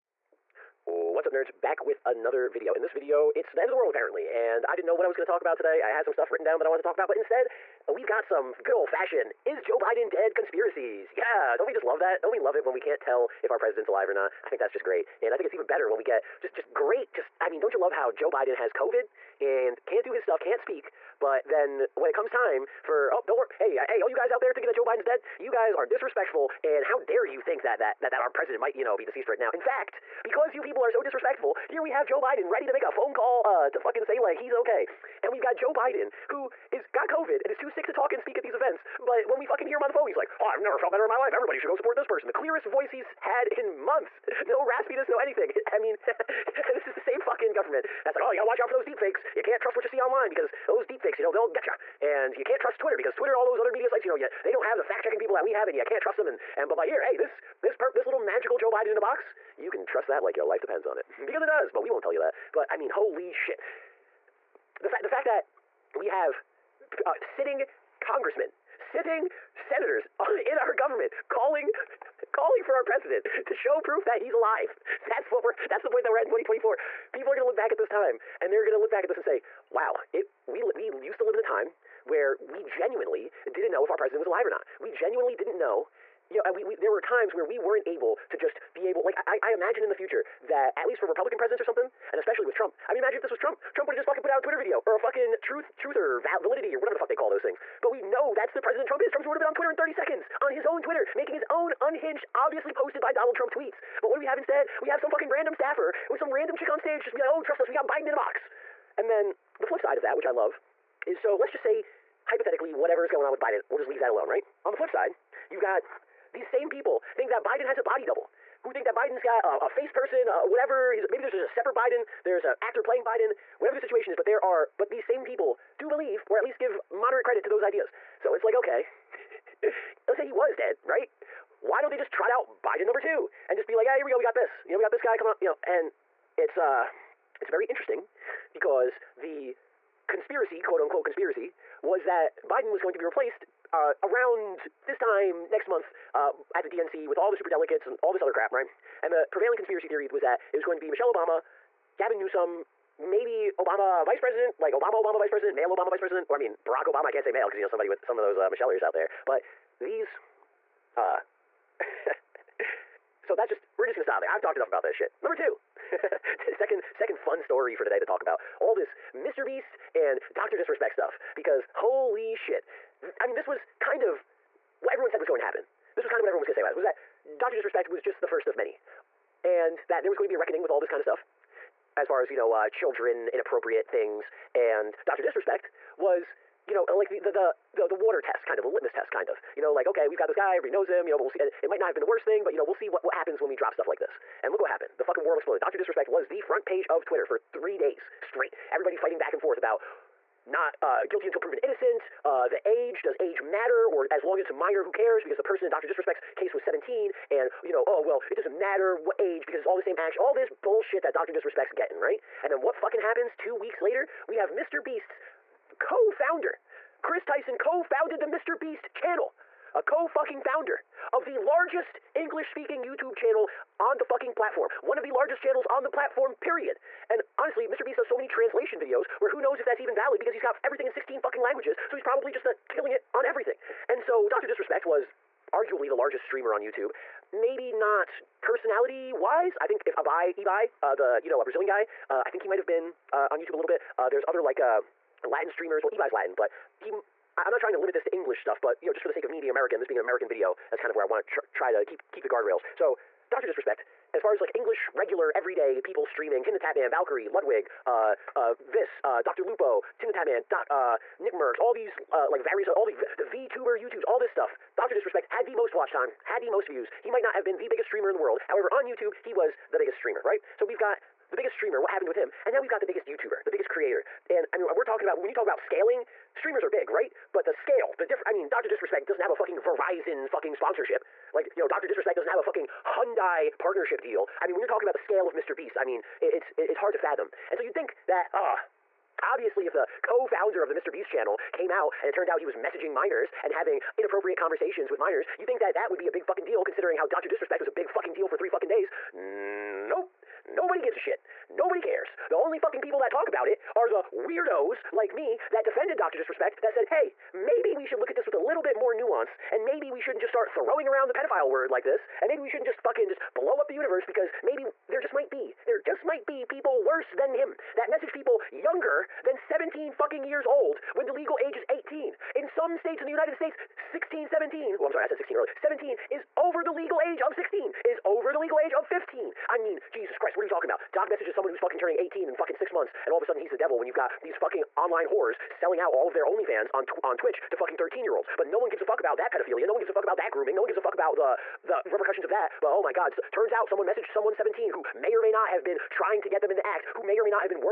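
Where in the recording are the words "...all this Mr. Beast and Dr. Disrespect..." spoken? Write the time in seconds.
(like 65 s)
168 s.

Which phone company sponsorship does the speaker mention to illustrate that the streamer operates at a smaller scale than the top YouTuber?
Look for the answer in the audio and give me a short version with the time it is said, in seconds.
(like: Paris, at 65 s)
Verizon, at 279 s.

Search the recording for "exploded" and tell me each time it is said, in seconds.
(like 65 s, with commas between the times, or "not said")
195 s.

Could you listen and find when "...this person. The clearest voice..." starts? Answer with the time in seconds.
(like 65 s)
41 s.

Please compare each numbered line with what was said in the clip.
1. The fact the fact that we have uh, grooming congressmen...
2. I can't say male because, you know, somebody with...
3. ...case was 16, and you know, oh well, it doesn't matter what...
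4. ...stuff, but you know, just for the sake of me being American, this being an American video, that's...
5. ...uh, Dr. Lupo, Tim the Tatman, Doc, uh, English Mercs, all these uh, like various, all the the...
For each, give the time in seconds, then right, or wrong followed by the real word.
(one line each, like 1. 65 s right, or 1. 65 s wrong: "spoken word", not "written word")
1. 64 s wrong: "sitting", not "grooming"
2. 157 s right
3. 206 s wrong: "17", not "16"
4. 248 s right
5. 259 s wrong: "Nick", not "English".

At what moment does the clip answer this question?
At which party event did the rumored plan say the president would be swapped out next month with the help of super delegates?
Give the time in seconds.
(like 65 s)
146 s.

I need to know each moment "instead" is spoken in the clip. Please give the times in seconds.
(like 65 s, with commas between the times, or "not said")
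7 s, 104 s.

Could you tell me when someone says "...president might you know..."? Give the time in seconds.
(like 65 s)
28 s.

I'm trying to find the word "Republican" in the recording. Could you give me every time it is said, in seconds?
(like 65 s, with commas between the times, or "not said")
91 s.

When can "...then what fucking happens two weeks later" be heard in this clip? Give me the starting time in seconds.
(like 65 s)
212 s.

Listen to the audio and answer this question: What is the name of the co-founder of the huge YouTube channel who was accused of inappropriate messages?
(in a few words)
Chris Tyson.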